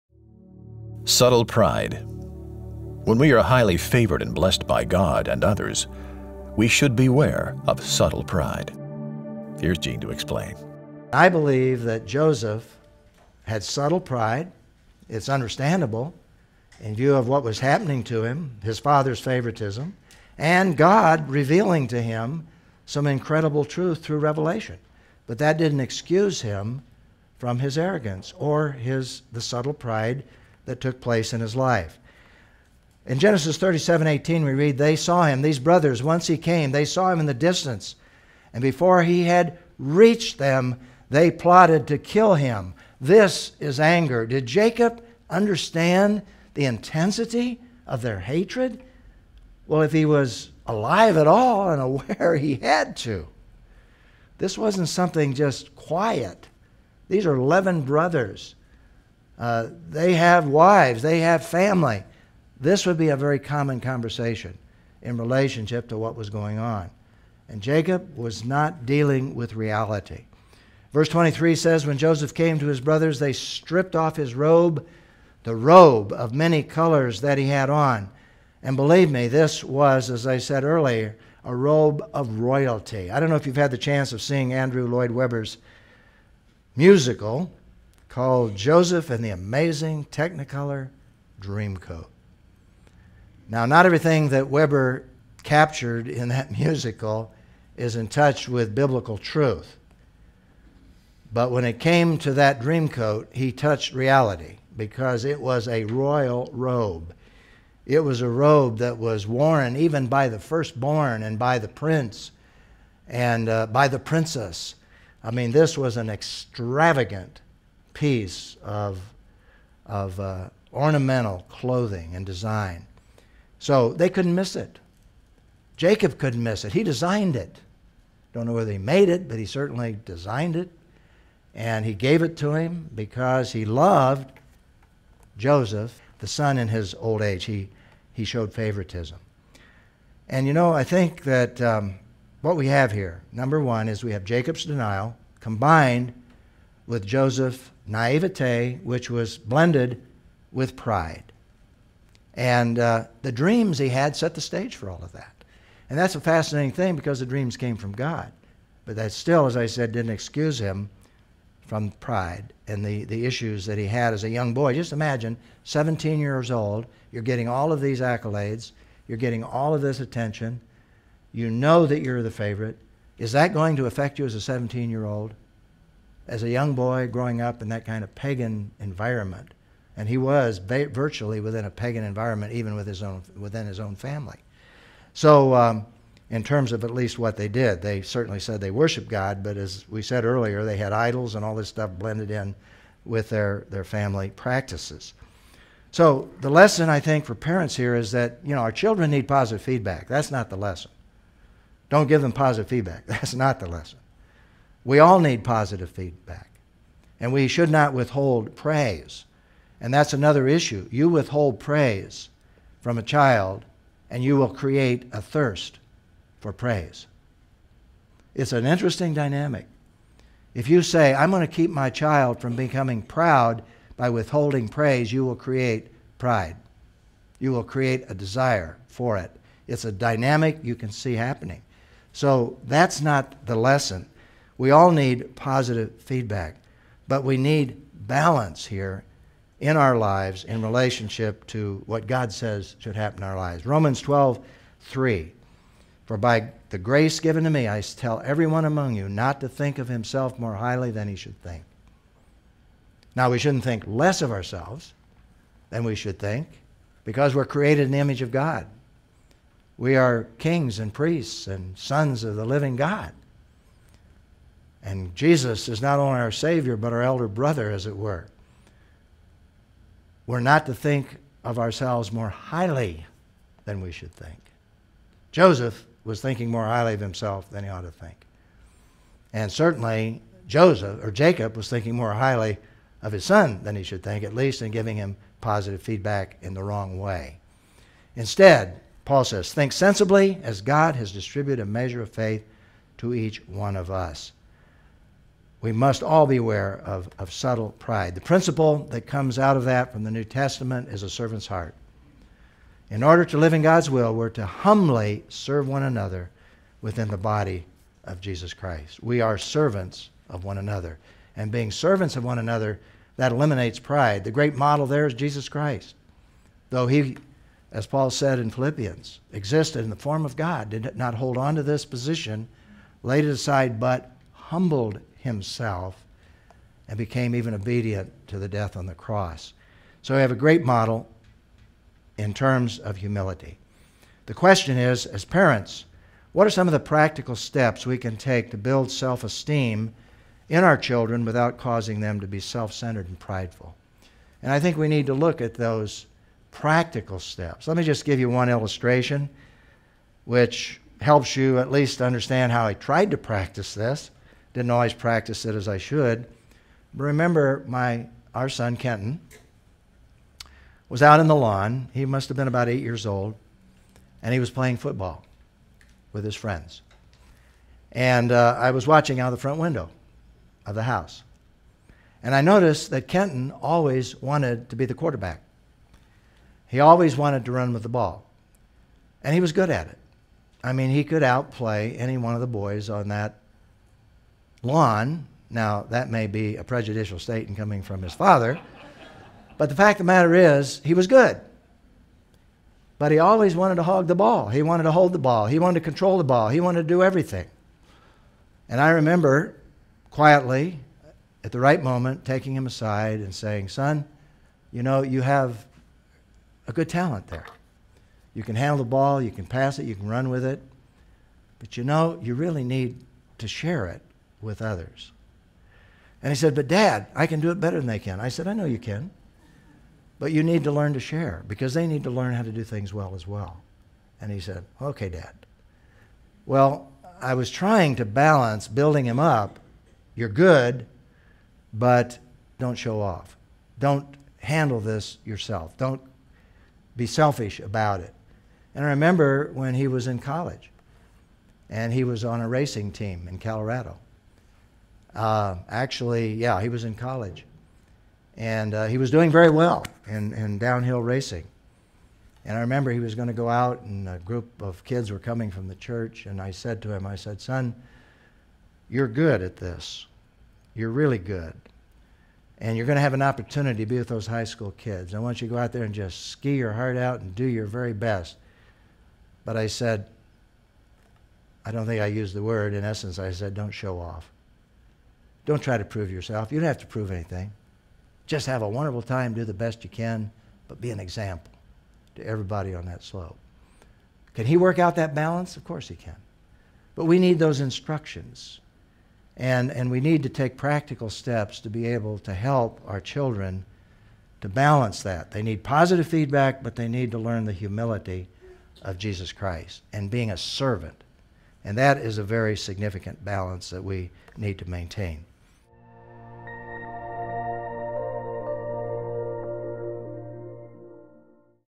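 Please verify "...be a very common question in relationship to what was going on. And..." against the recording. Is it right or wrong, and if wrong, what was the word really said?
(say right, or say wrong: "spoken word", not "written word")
wrong: "conversation", not "question".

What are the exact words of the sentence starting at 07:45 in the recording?
I want you to go out there and just ski your heart out and do your very best.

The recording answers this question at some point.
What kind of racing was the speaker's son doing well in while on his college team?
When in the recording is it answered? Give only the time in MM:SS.
07:30.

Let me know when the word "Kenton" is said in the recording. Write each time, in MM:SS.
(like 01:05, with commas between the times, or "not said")
05:58, 06:13.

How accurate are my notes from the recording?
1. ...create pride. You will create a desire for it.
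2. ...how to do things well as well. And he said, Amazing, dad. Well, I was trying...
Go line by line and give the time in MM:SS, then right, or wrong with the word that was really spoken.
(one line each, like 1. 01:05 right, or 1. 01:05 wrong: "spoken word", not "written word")
1. 03:45 right
2. 07:02 wrong: "Okay", not "Amazing".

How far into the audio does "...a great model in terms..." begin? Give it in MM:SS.
05:30.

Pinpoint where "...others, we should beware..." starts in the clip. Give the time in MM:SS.
00:05.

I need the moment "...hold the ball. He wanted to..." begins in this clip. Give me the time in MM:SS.
06:34.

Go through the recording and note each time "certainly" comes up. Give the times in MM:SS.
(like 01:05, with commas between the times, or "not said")
02:09, 03:08, 04:39.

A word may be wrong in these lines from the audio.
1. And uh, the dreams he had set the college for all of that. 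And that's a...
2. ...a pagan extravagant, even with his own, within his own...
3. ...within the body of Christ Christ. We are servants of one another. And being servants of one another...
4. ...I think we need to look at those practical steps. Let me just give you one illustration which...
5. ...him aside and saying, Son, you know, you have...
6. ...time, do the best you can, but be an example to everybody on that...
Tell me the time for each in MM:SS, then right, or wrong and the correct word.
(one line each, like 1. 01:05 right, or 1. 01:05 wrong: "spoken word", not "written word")
1. 02:32 wrong: "stage", not "college"
2. 03:01 wrong: "environment", not "extravagant"
3. 05:06 wrong: "Jesus", not "Christ"
4. 05:44 right
5. 06:42 right
6. 07:59 right.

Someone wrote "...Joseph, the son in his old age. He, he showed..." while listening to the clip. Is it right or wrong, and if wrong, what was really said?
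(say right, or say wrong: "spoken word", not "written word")
right.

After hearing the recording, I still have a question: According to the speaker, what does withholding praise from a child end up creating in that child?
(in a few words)
a thirst for praise.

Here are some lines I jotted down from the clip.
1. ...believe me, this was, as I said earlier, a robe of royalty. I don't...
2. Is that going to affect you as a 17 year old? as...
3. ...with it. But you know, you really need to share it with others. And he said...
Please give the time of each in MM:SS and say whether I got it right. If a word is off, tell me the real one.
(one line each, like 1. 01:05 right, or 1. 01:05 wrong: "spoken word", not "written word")
1. 01:18 right
2. 02:53 right
3. 06:50 right.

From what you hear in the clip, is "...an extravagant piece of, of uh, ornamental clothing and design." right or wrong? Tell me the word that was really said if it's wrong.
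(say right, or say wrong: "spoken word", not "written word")
right.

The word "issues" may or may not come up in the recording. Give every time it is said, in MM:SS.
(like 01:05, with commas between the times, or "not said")
02:43, 03:30.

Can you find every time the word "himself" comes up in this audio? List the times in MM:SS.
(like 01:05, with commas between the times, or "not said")
04:09, 04:36, 05:25.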